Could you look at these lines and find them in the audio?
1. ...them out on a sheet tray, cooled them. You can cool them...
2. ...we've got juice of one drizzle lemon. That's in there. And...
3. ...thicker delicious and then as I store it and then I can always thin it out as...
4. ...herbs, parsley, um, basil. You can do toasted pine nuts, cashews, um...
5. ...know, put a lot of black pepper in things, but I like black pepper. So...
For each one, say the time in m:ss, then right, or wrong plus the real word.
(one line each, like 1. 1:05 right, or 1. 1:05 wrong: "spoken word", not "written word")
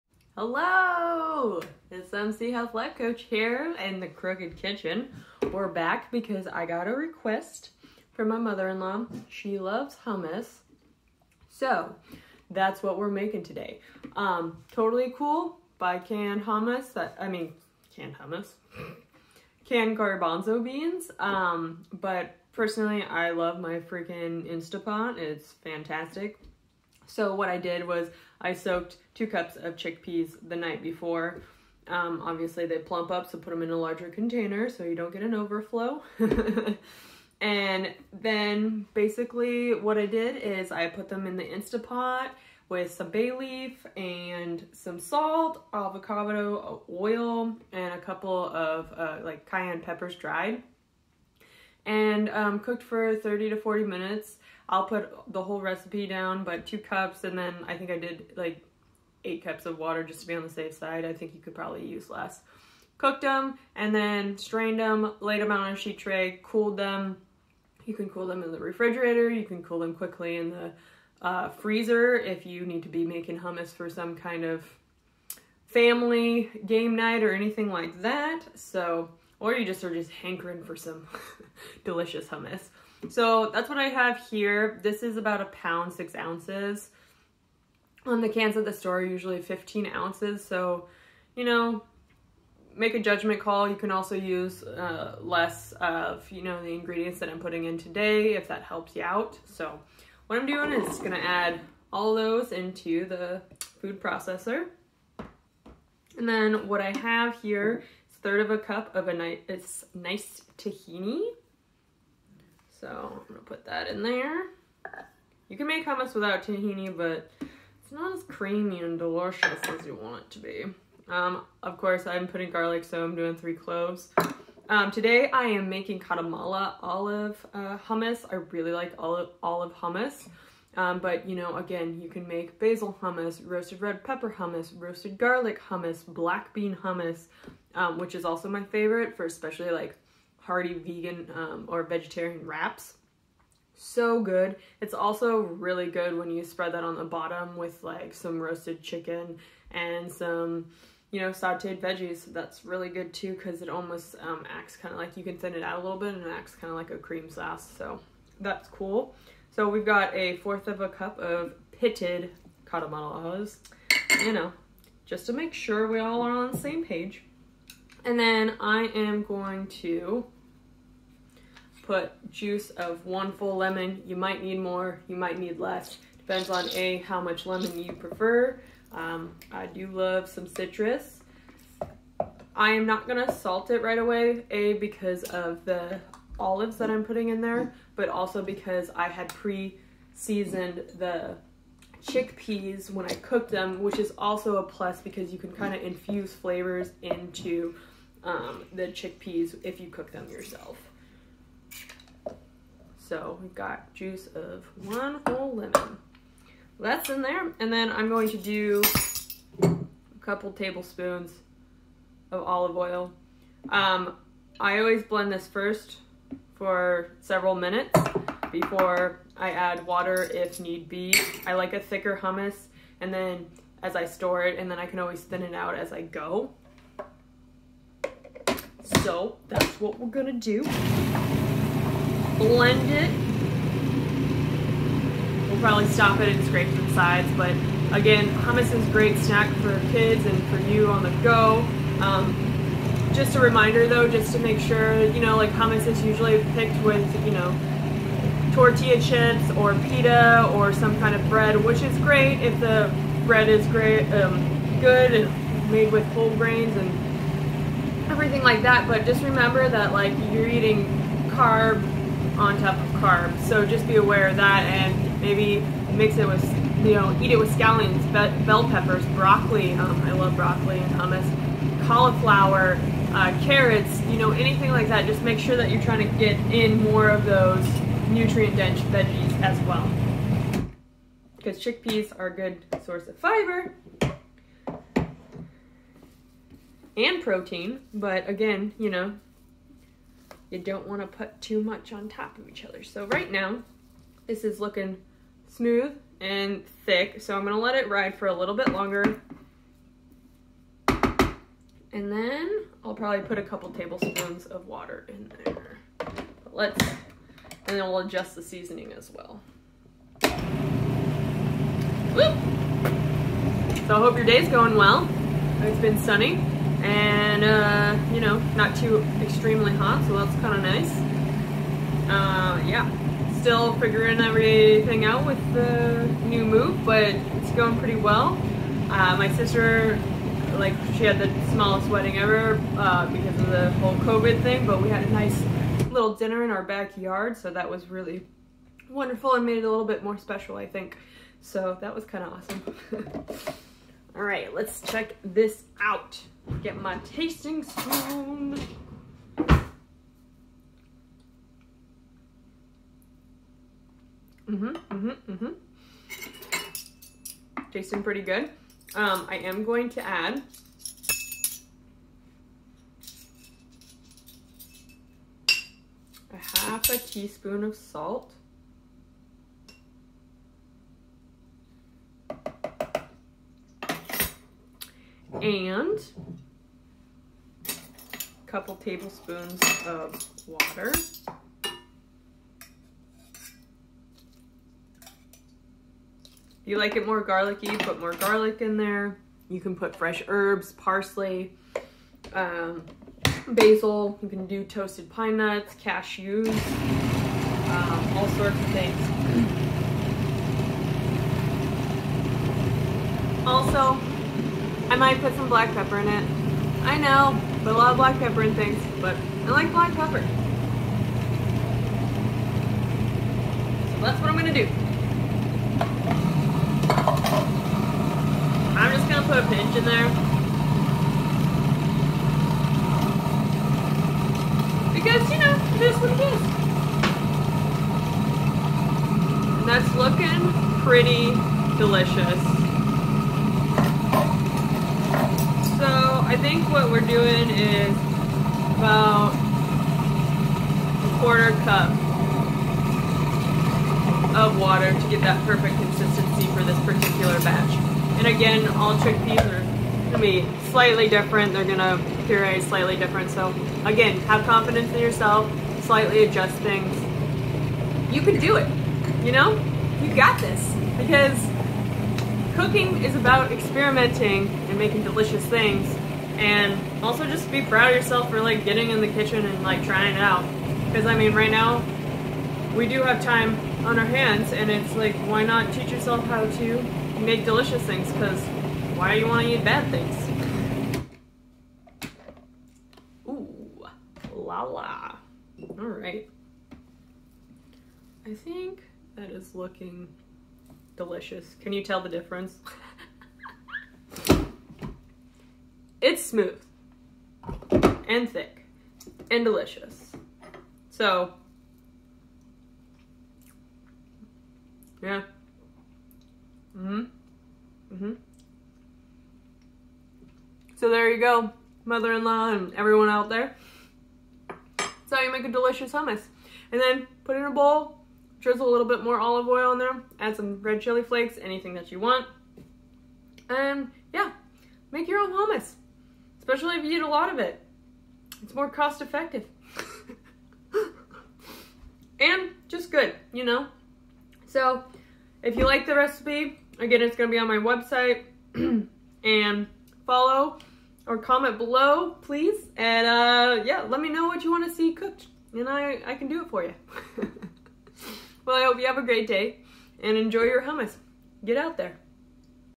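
1. 1:05 right
2. 3:23 wrong: "whole", not "drizzle"
3. 3:41 wrong: "hummus", not "delicious"
4. 6:30 right
5. 6:46 right.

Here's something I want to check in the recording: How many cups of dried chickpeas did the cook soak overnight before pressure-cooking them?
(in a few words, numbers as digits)
2.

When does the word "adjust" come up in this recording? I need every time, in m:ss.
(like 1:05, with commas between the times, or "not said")
5:07, 7:36.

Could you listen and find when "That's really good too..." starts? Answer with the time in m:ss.
2:32.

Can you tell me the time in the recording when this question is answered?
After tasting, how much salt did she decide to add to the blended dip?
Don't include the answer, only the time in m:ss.
6:06.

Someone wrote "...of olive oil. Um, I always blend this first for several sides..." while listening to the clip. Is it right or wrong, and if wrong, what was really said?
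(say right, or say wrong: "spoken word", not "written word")
wrong: "minutes", not "sides".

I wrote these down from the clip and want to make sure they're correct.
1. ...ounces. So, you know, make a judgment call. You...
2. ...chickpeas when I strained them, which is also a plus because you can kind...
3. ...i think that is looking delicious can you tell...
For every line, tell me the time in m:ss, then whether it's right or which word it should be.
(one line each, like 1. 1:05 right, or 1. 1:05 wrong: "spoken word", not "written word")
1. 1:29 right
2. 3:12 wrong: "cooked", not "strained"
3. 8:08 right.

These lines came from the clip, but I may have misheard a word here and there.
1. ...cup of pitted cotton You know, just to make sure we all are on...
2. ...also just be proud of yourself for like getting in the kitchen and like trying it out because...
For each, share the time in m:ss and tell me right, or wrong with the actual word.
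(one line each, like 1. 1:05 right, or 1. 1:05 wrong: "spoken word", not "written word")
1. 2:40 right
2. 7:47 right.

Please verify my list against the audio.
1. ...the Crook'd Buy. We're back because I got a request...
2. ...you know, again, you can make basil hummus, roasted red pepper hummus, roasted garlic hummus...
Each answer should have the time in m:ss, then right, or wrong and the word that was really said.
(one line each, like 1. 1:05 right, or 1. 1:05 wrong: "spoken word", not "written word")
1. 0:03 wrong: "Kitchen", not "Buy"
2. 2:11 right.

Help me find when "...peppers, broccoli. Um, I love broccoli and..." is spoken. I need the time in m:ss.
4:28.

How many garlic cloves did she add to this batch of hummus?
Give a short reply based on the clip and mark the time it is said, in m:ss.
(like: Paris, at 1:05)
3, at 2:03.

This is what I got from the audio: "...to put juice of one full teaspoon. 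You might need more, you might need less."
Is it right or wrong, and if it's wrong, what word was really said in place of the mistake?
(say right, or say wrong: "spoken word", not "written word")
wrong: "lemon", not "teaspoon".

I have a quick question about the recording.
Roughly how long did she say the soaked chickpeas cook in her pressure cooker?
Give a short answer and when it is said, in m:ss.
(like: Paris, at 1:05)
30 to 40 minutes, at 0:53.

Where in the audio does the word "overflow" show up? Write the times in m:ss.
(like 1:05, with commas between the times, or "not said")
0:35.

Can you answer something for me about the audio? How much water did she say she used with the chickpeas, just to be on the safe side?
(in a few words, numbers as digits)
8 cups.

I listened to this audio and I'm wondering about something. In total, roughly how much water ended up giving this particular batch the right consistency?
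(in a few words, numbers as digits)
a quarter cup.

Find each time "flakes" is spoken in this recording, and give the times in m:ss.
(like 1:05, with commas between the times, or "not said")
8:41.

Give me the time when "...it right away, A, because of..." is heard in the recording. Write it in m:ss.
3:03.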